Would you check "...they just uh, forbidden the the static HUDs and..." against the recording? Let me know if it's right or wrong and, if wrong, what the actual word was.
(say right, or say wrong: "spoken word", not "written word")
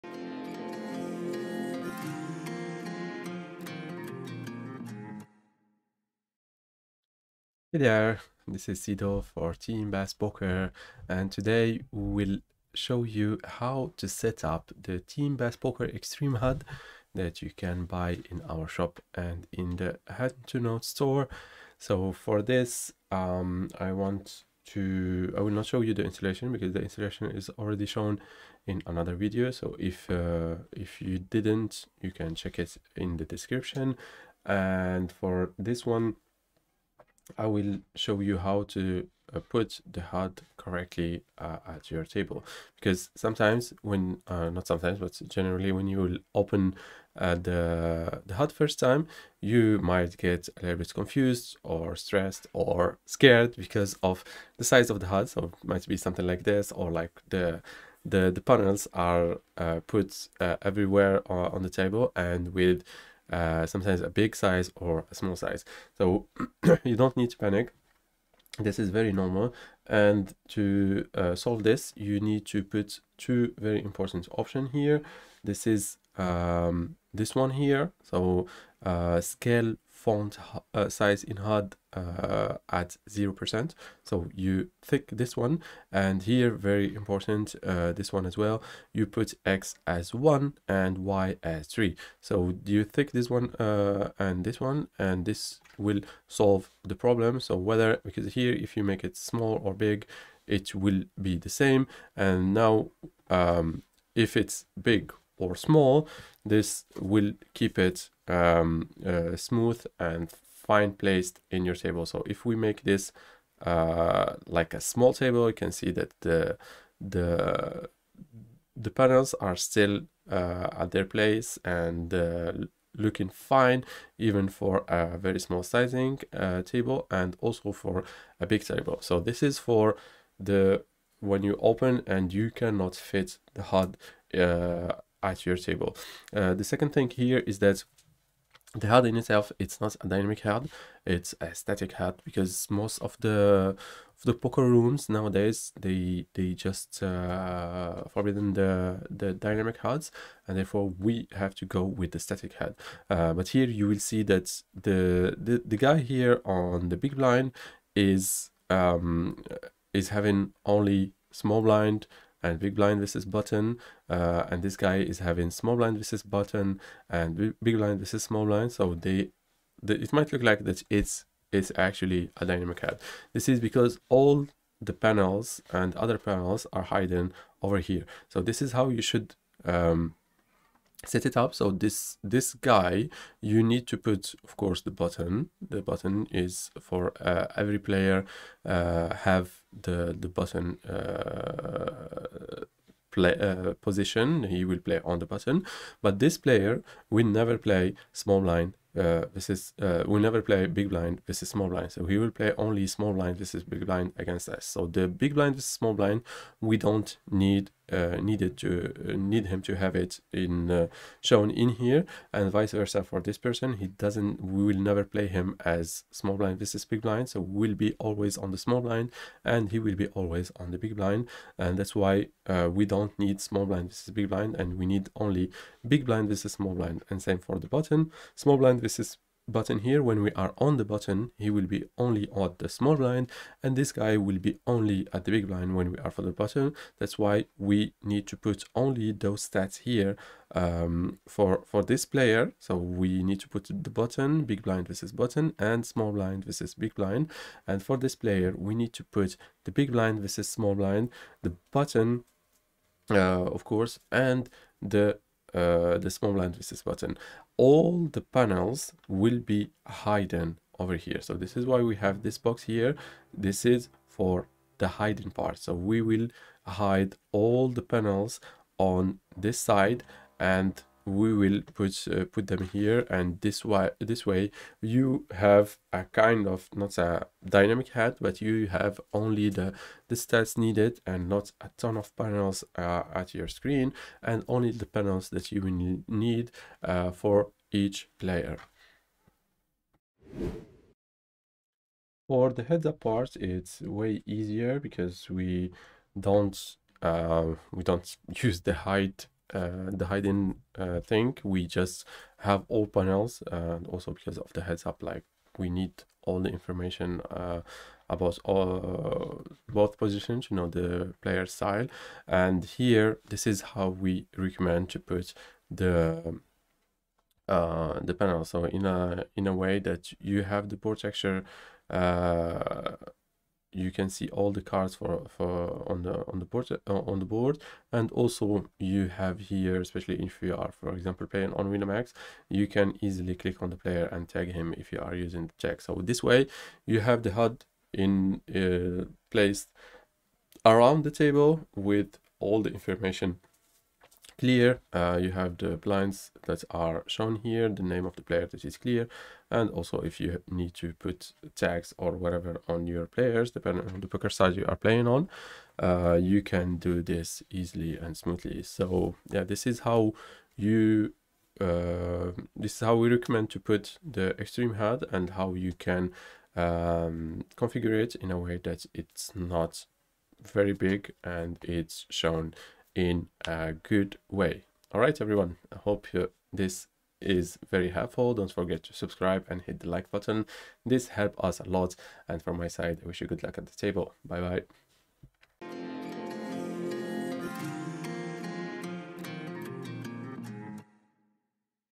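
wrong: "dynamic", not "static".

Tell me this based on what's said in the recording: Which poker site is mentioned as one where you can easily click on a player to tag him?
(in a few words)
Winamax.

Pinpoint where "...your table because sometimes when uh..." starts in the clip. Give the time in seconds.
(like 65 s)
41 s.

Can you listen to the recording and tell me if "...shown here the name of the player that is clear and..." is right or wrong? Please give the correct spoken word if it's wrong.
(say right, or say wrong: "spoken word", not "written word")
right.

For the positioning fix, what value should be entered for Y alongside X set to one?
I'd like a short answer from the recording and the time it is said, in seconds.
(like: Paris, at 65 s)
3, at 91 s.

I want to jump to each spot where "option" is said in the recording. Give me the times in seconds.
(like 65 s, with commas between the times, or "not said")
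74 s.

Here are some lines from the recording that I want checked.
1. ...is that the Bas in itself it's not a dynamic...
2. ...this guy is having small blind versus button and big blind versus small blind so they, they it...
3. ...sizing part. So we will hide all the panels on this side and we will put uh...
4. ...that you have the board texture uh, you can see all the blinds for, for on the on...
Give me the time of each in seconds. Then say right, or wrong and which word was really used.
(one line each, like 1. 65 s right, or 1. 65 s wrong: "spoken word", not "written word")
1. 137 s wrong: "HUD", not "Bas"
2. 164 s right
3. 264 s wrong: "hiding", not "sizing"
4. 319 s wrong: "cards", not "blinds".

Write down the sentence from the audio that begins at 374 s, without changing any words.
All right, everyone, I hope you, this is very helpful.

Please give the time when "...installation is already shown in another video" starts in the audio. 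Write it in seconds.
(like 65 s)
26 s.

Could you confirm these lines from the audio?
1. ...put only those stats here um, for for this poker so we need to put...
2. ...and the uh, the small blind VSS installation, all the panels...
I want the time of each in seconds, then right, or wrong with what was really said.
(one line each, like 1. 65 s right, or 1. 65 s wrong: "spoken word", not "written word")
1. 238 s wrong: "player", not "poker"
2. 254 s wrong: "button", not "installation".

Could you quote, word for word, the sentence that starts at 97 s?
So whether, because here, if you make it small or big, it will be the same.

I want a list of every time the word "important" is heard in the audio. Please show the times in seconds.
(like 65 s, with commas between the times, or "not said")
73 s, 87 s.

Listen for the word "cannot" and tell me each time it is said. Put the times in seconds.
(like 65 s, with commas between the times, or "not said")
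132 s.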